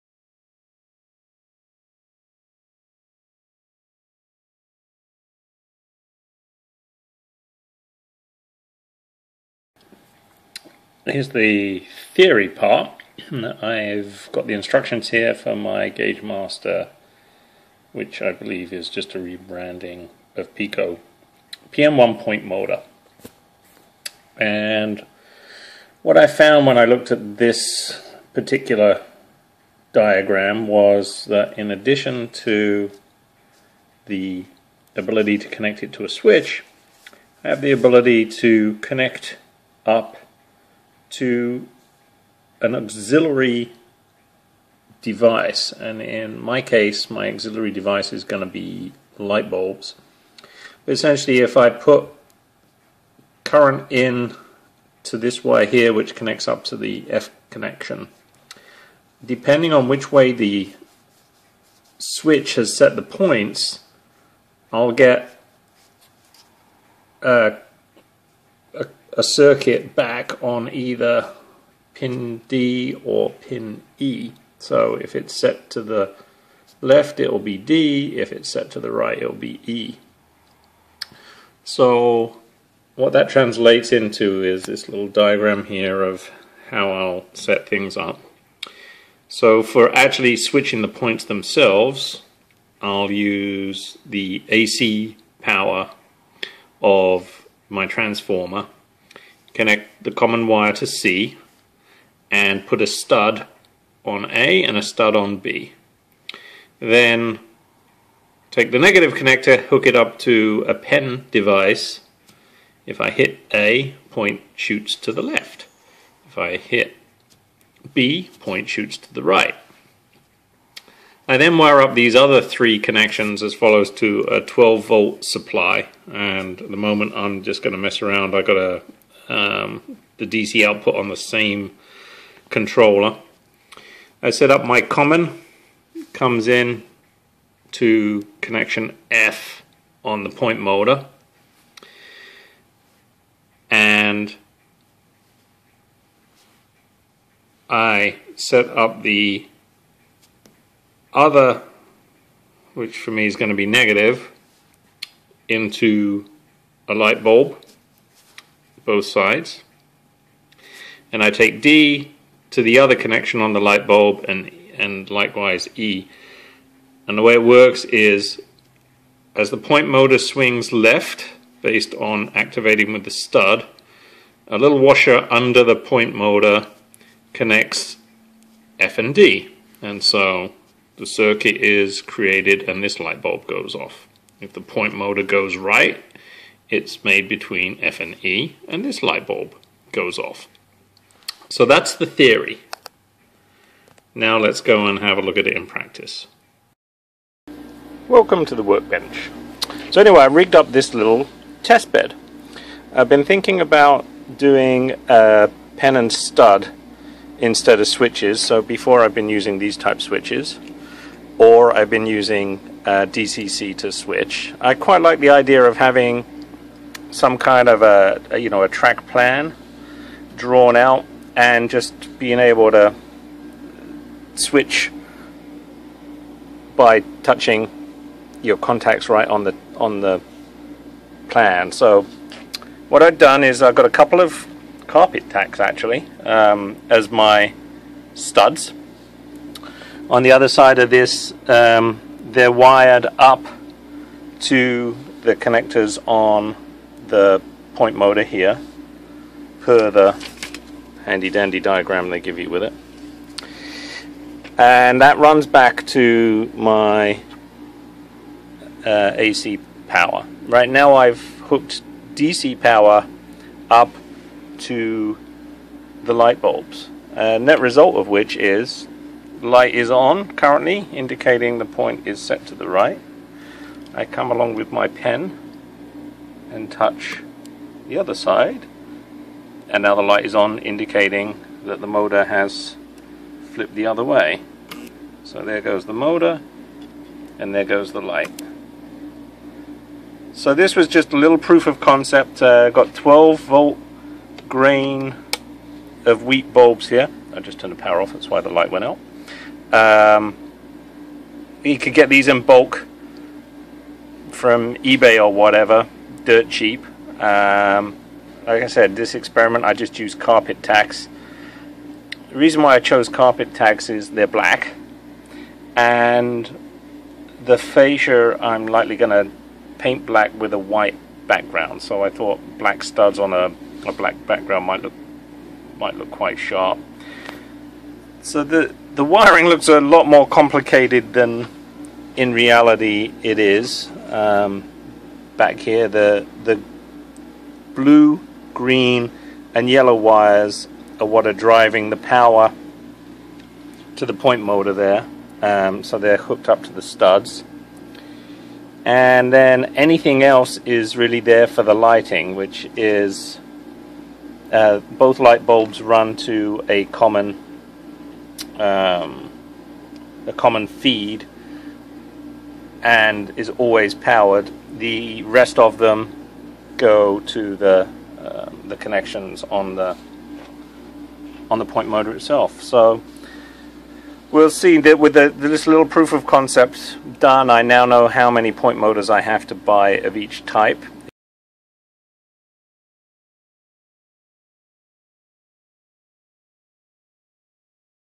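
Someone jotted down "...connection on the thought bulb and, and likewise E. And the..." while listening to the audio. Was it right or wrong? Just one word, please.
wrong.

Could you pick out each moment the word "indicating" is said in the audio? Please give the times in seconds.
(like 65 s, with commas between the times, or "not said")
270 s, 280 s.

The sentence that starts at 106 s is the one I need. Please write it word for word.
Then take the negative connector, hook it up to a pen device.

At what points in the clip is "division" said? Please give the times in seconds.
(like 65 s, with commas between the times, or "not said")
not said.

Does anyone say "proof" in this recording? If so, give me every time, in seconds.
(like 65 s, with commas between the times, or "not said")
291 s, 375 s.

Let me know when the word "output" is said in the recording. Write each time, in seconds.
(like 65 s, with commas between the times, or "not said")
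130 s.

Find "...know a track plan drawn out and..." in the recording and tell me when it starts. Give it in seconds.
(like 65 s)
218 s.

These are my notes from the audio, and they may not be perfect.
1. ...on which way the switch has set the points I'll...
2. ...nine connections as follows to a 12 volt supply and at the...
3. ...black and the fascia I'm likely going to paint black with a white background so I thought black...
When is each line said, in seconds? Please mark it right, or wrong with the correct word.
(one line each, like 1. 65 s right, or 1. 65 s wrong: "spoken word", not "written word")
1. 59 s right
2. 122 s wrong: "three", not "nine"
3. 314 s right.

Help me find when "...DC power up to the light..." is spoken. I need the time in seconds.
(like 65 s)
262 s.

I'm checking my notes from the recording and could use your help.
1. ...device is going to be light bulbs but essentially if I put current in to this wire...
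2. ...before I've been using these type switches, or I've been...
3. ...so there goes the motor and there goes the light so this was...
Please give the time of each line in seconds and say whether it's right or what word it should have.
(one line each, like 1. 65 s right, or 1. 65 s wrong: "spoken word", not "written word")
1. 47 s right
2. 208 s right
3. 285 s right.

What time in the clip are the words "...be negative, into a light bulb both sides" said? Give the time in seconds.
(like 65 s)
153 s.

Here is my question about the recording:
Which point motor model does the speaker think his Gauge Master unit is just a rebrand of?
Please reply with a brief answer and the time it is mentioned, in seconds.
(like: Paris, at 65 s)
Peco PM-1, at 20 s.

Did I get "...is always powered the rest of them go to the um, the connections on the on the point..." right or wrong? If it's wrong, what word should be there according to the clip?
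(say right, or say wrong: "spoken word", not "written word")
right.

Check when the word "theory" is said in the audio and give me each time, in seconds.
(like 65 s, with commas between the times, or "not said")
12 s, 192 s.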